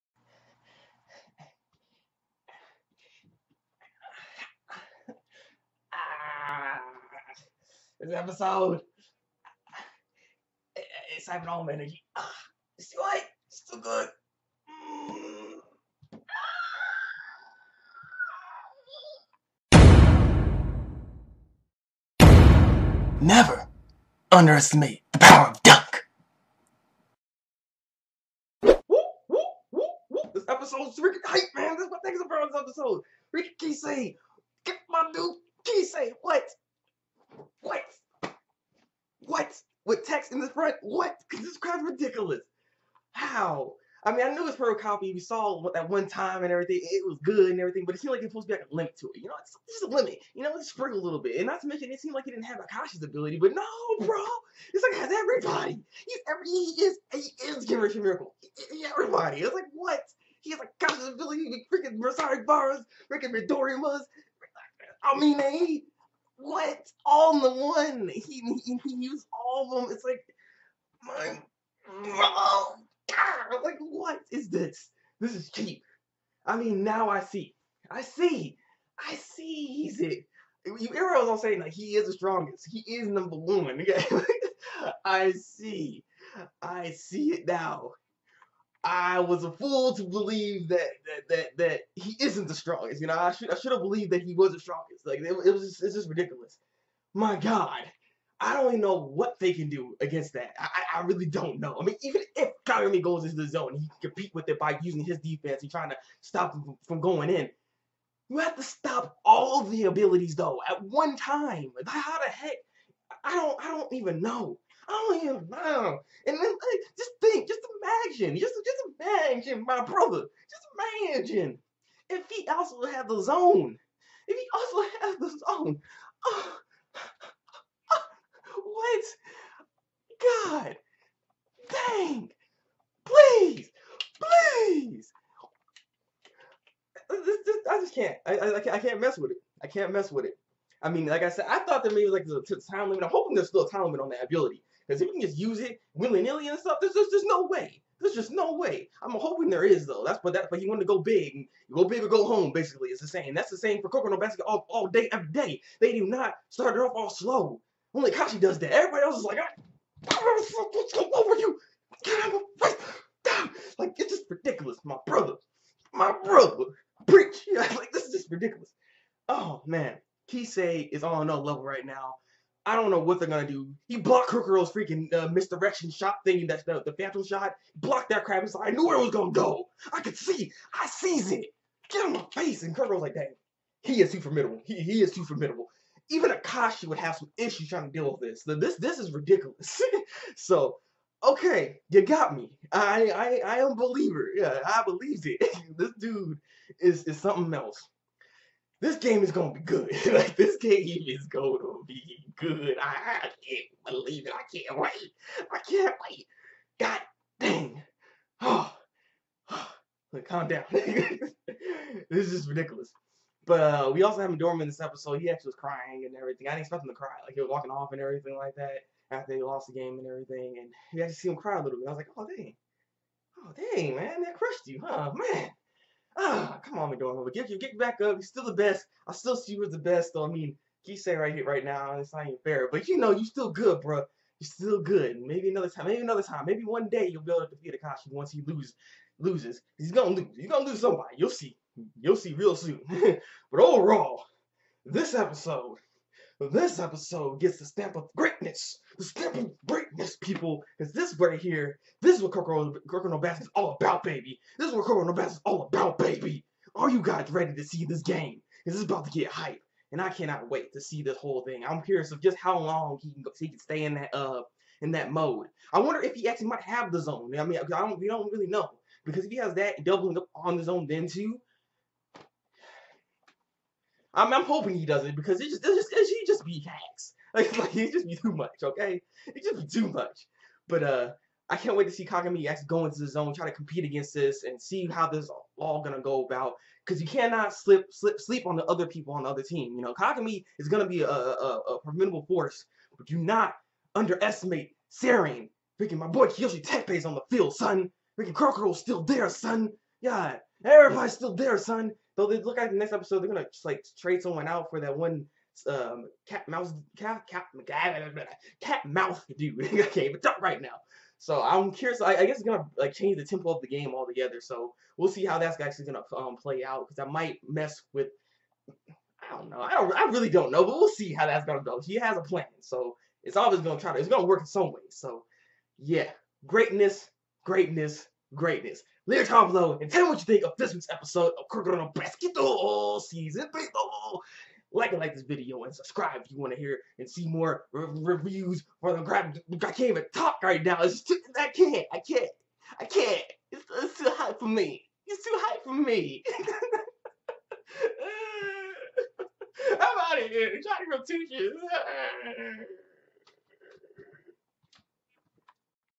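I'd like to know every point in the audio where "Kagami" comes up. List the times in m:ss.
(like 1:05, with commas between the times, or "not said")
4:42, 4:49.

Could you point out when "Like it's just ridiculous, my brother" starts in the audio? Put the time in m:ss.
2:43.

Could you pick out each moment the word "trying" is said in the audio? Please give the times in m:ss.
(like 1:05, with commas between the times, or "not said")
1:45, 3:07.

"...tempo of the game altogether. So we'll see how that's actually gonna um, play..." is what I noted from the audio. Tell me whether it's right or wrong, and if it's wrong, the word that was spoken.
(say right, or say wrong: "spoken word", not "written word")
right.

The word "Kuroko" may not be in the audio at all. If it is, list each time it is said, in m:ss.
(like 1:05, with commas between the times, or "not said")
2:54, 3:02.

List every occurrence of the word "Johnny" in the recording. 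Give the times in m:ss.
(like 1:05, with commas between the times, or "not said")
5:50.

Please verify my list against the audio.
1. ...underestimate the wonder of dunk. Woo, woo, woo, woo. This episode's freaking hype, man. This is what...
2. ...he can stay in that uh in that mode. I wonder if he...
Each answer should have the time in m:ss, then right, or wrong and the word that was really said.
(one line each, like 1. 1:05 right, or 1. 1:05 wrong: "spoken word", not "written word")
1. 0:24 wrong: "power", not "wonder"
2. 4:23 right.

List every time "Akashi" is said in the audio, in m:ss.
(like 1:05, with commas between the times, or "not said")
0:52, 1:00, 3:06, 3:57.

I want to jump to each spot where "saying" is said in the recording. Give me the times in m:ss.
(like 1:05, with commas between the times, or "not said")
1:21, 3:50.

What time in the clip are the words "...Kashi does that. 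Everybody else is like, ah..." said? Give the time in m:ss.
2:38.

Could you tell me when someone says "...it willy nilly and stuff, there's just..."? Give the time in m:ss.
2:25.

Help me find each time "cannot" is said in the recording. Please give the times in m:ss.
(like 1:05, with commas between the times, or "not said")
4:20, 4:47.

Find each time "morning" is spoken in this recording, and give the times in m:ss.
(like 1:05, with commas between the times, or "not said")
not said.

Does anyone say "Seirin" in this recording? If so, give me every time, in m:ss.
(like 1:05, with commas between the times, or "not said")
4:54.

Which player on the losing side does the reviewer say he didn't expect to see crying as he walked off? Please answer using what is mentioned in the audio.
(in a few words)
Dorman.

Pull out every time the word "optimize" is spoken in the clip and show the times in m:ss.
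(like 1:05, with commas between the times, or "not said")
not said.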